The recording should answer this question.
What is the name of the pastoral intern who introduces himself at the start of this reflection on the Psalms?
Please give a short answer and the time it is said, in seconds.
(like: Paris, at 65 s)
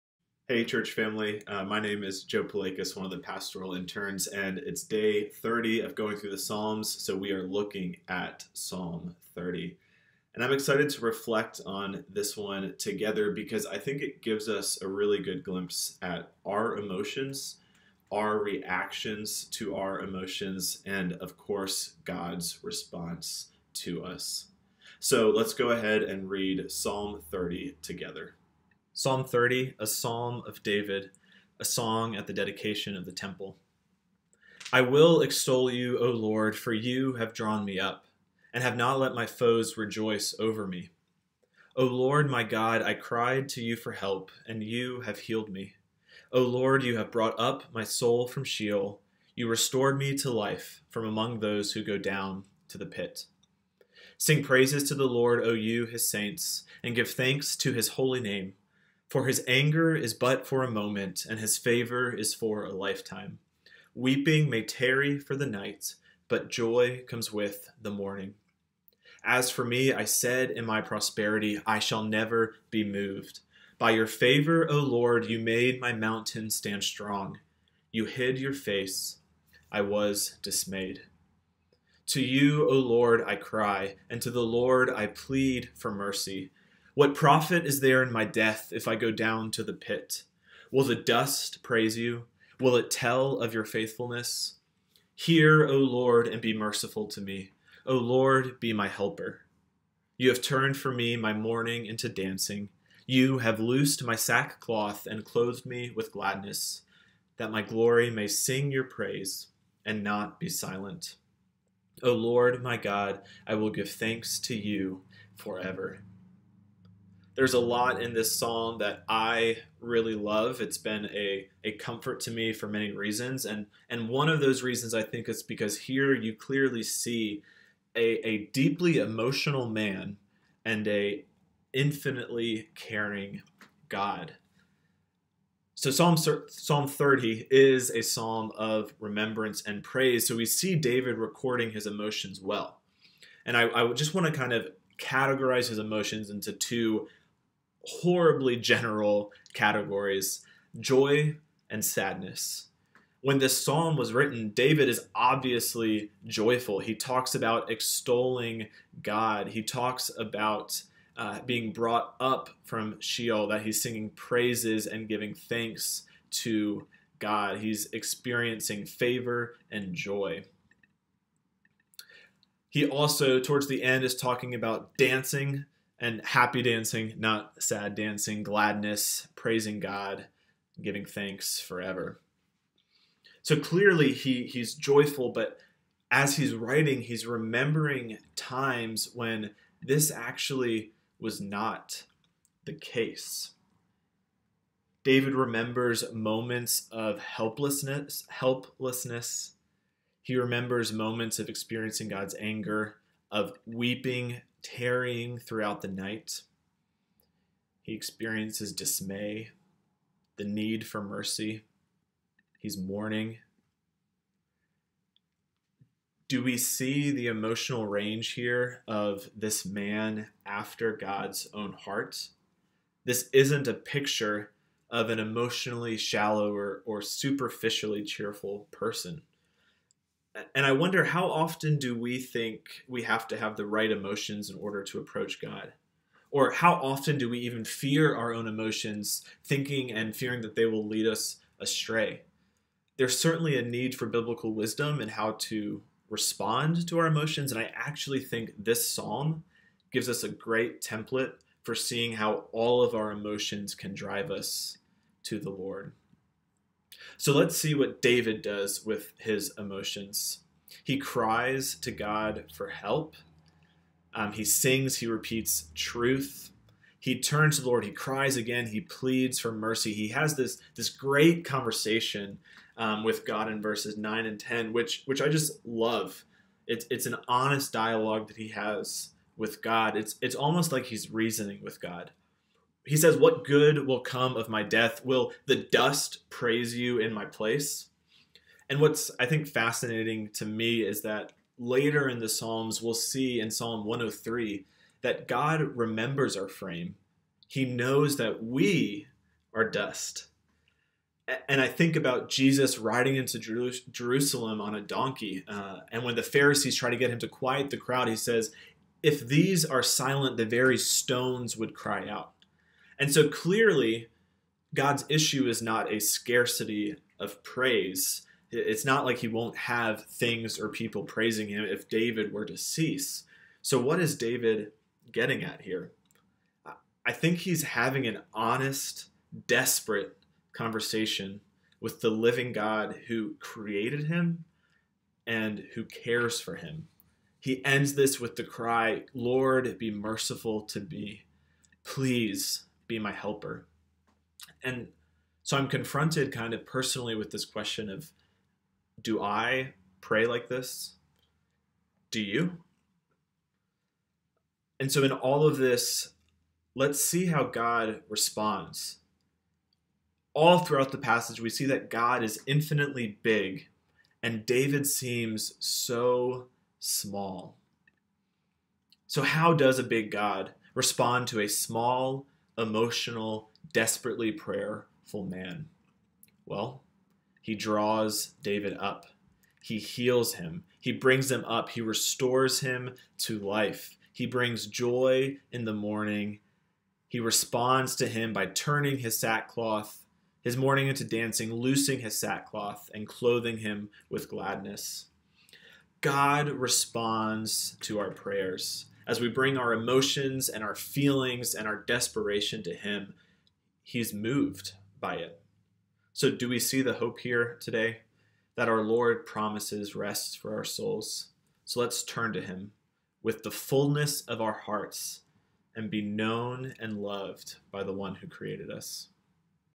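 Joe Palakis, at 2 s.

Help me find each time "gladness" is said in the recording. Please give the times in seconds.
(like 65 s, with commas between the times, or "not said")
106 s, 178 s, 394 s.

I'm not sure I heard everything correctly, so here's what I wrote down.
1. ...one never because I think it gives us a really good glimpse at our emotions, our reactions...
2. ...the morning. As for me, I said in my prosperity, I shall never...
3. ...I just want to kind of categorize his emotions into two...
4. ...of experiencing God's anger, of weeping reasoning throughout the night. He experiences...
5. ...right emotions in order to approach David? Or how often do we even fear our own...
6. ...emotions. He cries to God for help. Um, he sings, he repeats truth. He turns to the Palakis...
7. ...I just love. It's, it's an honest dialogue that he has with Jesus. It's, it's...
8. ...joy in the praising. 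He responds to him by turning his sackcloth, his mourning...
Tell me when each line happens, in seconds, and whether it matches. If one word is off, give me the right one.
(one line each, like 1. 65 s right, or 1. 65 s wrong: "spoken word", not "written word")
1. 12 s wrong: "together", not "never"
2. 67 s right
3. 143 s right
4. 201 s wrong: "tarrying", not "reasoning"
5. 233 s wrong: "God", not "David"
6. 259 s wrong: "Lord", not "Palakis"
7. 275 s wrong: "God", not "Jesus"
8. 384 s wrong: "morning", not "praising".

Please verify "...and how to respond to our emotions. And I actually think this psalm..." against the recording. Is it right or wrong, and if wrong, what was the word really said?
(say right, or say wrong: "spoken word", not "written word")
right.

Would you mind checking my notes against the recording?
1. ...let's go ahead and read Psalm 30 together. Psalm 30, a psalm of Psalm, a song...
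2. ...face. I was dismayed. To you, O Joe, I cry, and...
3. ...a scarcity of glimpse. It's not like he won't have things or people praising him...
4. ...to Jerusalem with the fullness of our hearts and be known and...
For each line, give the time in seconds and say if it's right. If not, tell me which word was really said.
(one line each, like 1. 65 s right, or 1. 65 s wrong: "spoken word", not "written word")
1. 25 s wrong: "David", not "Psalm"
2. 78 s wrong: "Lord", not "Joe"
3. 315 s wrong: "praise", not "glimpse"
4. 412 s wrong: "Him", not "Jerusalem".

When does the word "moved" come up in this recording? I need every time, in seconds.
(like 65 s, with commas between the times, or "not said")
72 s, 404 s.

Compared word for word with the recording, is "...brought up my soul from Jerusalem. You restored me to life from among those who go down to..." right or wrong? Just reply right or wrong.
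wrong.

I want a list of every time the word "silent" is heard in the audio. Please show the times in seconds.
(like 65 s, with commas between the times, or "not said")
110 s, 309 s.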